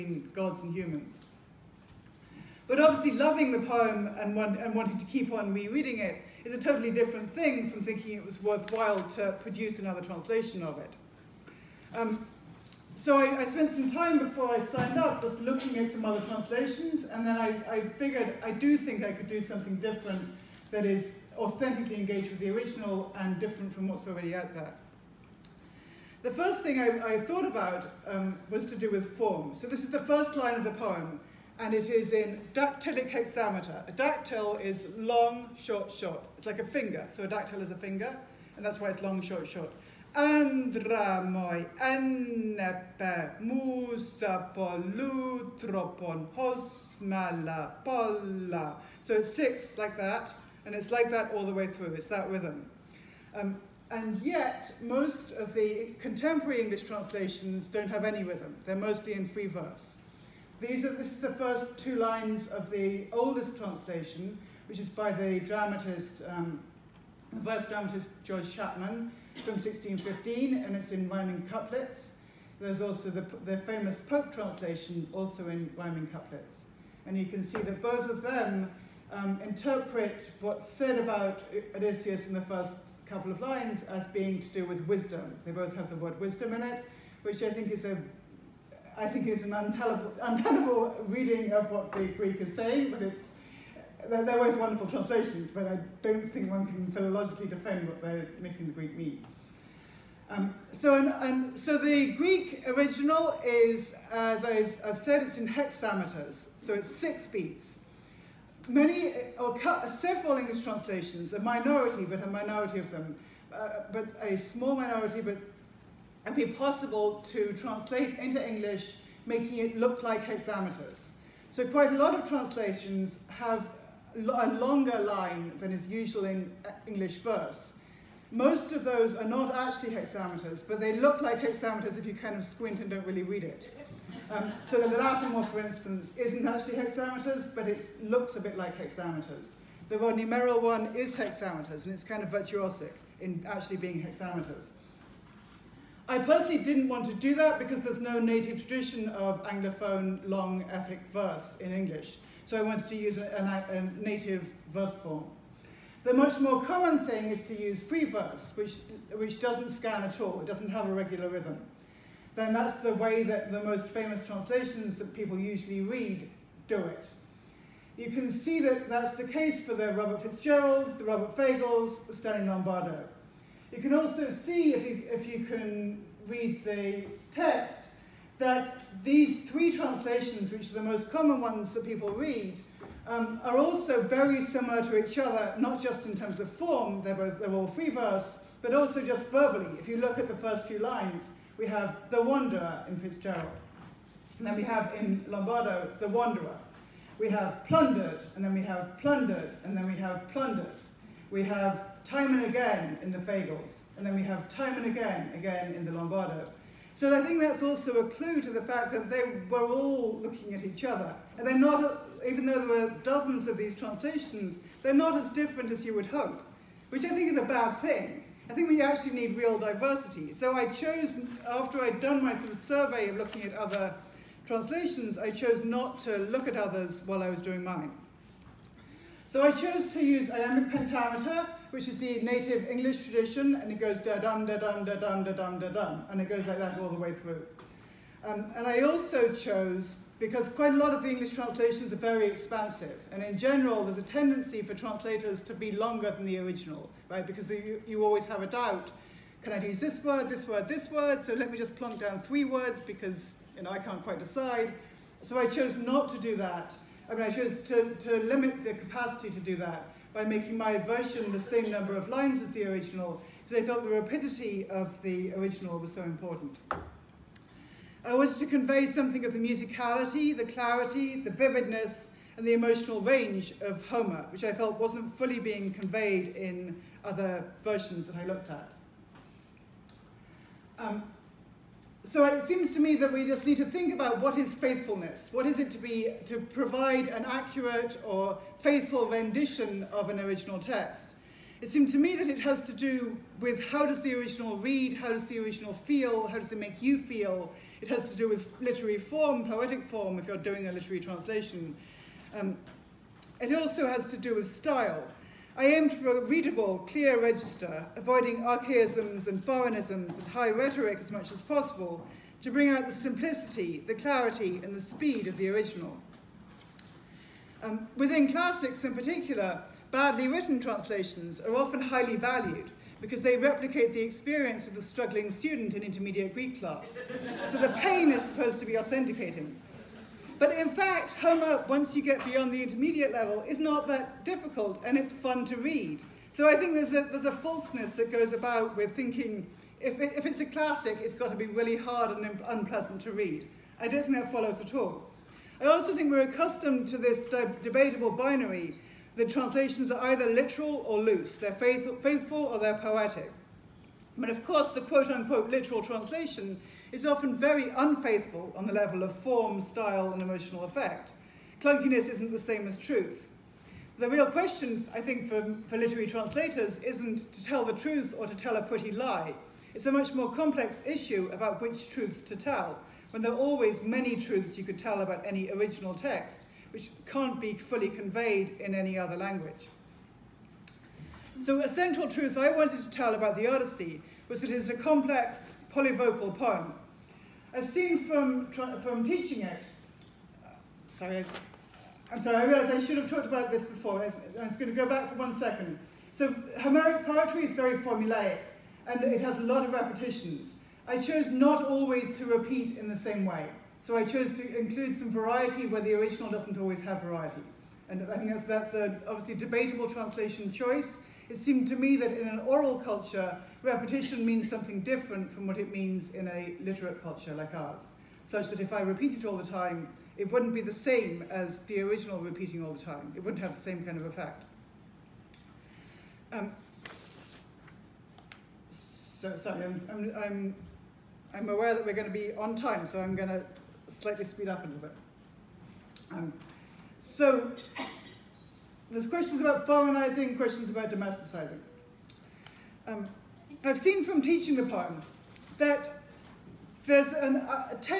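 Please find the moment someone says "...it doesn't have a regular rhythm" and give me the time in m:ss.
2:40.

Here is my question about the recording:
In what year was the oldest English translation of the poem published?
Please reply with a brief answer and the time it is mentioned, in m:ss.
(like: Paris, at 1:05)
1615, at 1:09.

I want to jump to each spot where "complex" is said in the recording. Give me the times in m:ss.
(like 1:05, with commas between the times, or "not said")
6:10, 6:24.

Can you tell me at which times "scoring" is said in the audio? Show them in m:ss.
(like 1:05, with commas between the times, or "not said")
not said.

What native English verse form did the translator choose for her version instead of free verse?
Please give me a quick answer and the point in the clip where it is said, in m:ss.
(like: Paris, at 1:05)
iambic pentameter, at 3:50.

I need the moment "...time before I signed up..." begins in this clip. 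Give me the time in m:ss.
0:13.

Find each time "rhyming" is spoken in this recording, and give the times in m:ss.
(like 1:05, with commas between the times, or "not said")
1:11, 1:15.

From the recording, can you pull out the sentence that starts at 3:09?
If you look at the first few lines, we have the wanderer in Fitzgerald.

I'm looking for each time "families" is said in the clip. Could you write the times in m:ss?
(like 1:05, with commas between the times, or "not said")
not said.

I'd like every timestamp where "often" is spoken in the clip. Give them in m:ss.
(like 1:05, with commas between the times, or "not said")
5:21, 5:57.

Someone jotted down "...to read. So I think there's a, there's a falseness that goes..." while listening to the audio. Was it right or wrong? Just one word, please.
right.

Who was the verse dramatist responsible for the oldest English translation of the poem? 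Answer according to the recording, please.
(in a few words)
George Chapman.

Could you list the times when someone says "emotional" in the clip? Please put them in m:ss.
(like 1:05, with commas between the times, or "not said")
4:32, 6:00.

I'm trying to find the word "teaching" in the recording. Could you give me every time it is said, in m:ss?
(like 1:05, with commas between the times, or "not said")
6:29, 7:24.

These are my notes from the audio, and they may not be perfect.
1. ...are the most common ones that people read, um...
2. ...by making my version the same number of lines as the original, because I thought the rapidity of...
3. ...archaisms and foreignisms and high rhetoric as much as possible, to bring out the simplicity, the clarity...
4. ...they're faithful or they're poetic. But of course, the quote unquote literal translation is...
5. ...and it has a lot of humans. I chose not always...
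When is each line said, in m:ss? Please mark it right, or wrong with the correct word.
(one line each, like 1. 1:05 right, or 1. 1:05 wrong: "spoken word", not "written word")
1. 3:00 right
2. 4:20 right
3. 5:08 right
4. 5:51 right
5. 6:38 wrong: "repetitions", not "humans".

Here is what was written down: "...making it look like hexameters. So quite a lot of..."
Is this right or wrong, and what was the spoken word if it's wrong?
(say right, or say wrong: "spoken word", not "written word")
right.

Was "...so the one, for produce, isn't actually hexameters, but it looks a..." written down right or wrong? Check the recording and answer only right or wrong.
wrong.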